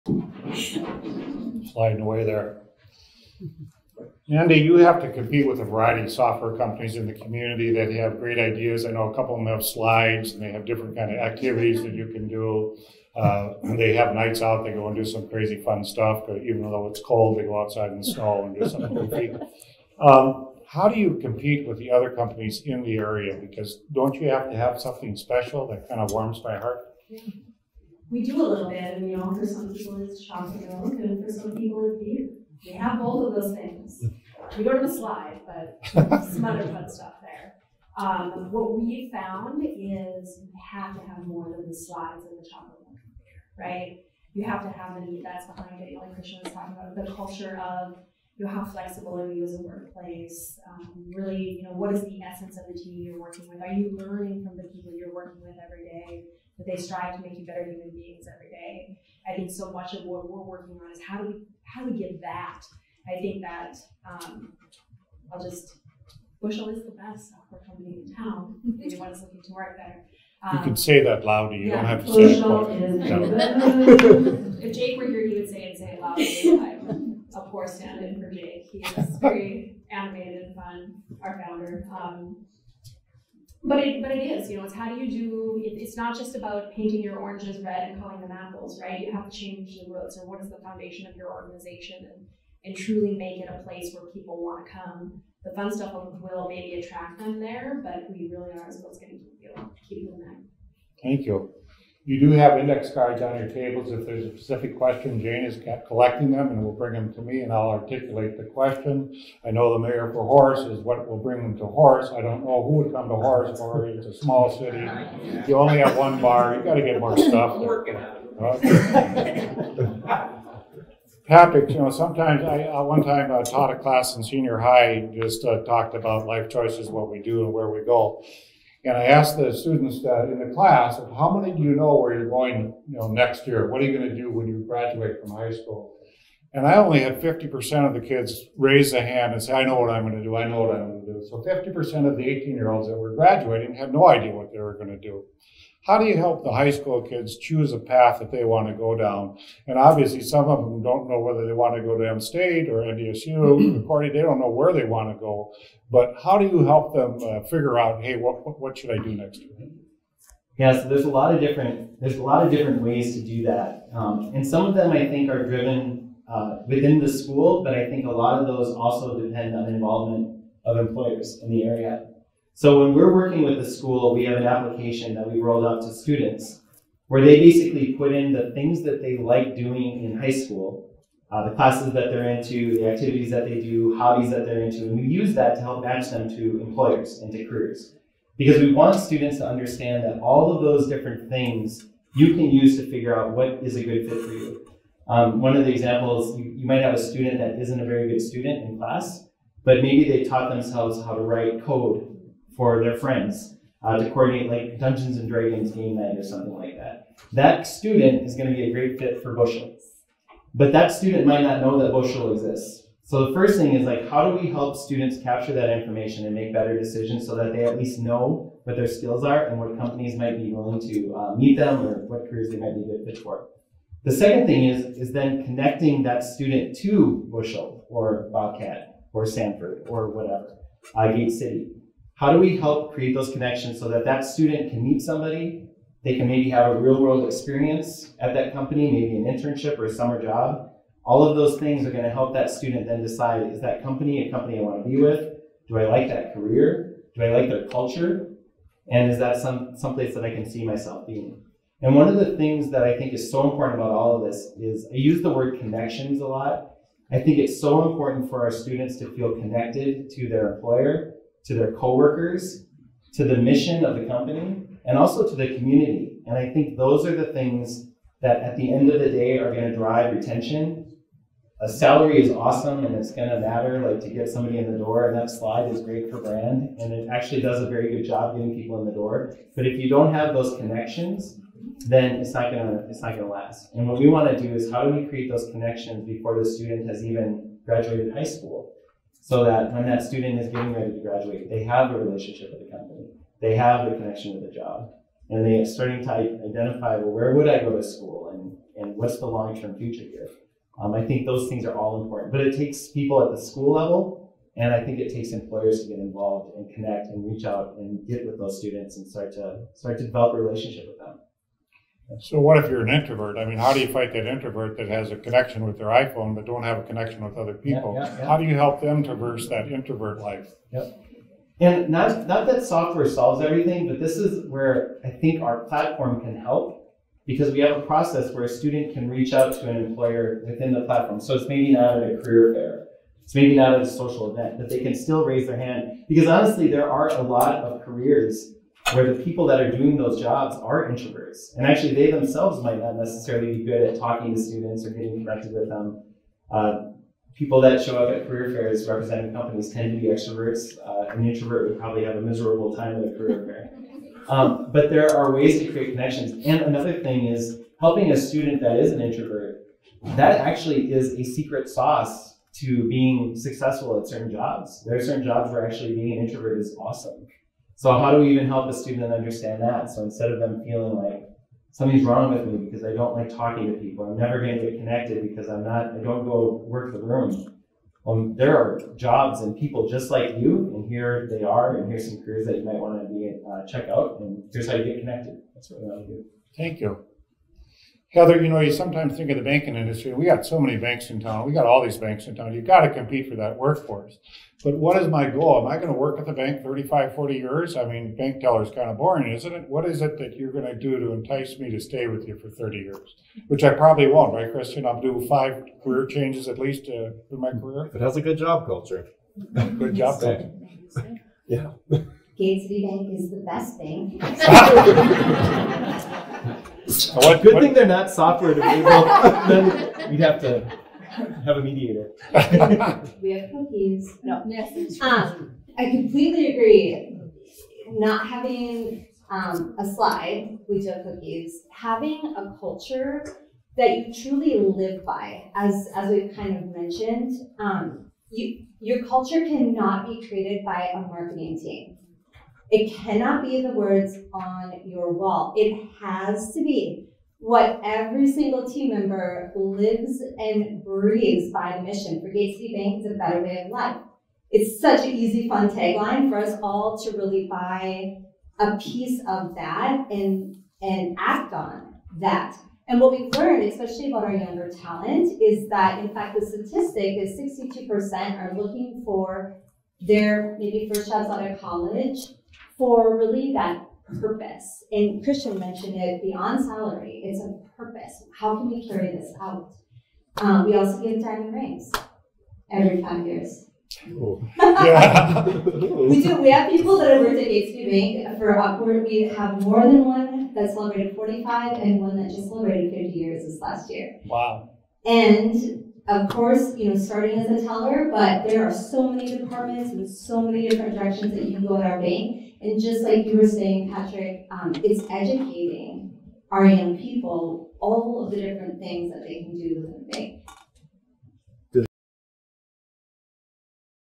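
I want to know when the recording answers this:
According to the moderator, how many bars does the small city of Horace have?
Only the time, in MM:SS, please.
01:55.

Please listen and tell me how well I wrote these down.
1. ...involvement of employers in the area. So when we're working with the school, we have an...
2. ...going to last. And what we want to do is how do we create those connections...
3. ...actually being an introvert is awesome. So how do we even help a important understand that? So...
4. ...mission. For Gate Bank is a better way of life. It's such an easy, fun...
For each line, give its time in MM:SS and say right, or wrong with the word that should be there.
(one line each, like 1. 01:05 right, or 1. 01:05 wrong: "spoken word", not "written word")
1. 02:49 right
2. 04:43 right
3. 06:05 wrong: "student", not "important"
4. 07:31 right.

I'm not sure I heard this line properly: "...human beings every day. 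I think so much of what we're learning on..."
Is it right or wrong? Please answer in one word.
wrong.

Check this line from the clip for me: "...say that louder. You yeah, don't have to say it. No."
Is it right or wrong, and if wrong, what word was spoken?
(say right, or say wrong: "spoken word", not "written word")
right.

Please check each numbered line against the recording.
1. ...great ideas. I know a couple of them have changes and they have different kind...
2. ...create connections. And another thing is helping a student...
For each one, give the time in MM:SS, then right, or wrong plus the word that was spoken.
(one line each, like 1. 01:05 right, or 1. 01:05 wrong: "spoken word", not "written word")
1. 00:08 wrong: "slides", not "changes"
2. 05:55 right.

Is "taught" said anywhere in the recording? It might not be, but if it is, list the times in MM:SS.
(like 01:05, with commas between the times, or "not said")
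02:03, 03:20.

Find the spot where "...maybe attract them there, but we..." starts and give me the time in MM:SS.
01:36.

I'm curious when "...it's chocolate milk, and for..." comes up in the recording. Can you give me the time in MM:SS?
00:30.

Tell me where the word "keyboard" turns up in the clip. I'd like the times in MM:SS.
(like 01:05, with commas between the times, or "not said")
not said.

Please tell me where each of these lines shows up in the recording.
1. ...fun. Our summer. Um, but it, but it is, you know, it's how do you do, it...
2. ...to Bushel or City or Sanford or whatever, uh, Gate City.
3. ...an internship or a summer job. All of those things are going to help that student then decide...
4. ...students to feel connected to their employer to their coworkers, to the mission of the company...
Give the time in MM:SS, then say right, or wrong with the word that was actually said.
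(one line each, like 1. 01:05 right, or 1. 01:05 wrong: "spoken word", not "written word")
1. 01:20 wrong: "founder", not "summer"
2. 03:46 wrong: "Bobcat", not "City"
3. 03:59 right
4. 04:18 right.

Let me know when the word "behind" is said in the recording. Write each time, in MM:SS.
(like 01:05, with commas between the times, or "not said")
00:45.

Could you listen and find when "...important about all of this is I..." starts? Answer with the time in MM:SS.
04:13.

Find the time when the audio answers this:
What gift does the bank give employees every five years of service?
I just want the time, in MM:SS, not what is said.
08:01.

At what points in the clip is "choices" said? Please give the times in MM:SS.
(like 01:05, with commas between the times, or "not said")
02:06.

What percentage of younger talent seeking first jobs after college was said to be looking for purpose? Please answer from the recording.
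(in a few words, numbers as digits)
62%.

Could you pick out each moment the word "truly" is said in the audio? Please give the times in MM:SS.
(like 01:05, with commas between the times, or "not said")
01:32, 07:14.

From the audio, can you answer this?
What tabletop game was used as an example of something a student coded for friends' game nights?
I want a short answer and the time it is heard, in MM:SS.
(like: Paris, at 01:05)
Dungeons and Dragons, at 03:24.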